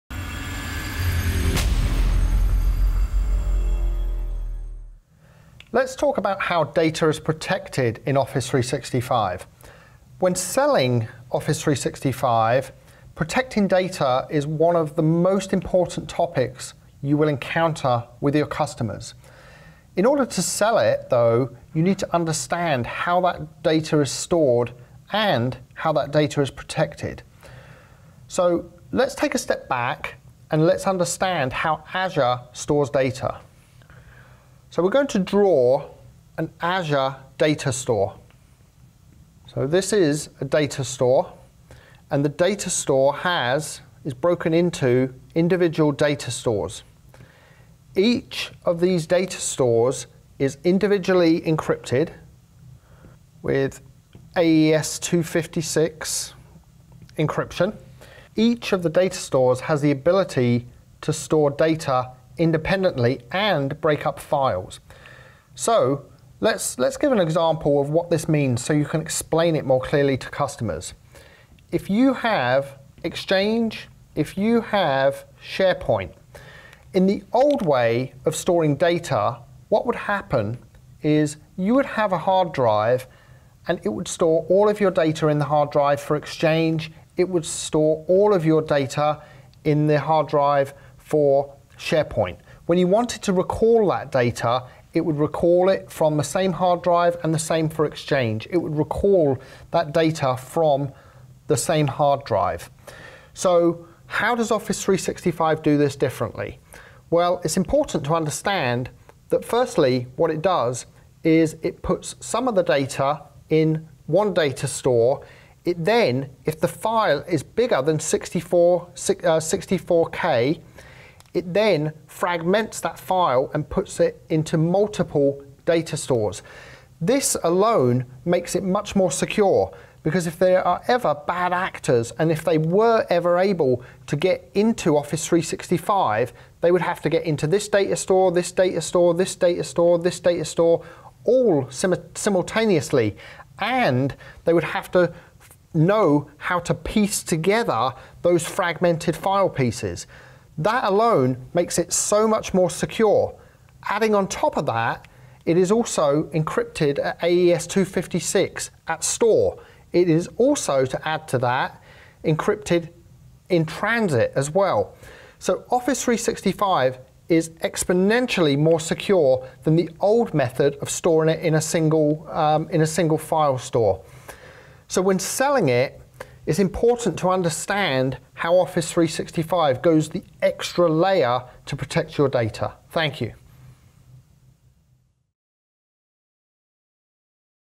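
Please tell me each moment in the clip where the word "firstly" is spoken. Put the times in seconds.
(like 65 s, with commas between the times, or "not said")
109 s.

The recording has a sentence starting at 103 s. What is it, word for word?
So how does Office 365 do this differently?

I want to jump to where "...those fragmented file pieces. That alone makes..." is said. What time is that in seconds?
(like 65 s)
148 s.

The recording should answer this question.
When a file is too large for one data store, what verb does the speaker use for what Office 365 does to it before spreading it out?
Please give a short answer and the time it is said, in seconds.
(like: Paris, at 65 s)
Fragments, at 122 s.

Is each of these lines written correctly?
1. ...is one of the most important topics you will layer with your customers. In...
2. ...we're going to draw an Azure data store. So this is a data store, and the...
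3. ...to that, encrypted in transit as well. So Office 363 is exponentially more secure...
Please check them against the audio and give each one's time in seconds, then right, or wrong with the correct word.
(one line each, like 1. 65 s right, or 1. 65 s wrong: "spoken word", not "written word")
1. 14 s wrong: "encounter", not "layer"
2. 34 s right
3. 161 s wrong: "365", not "363".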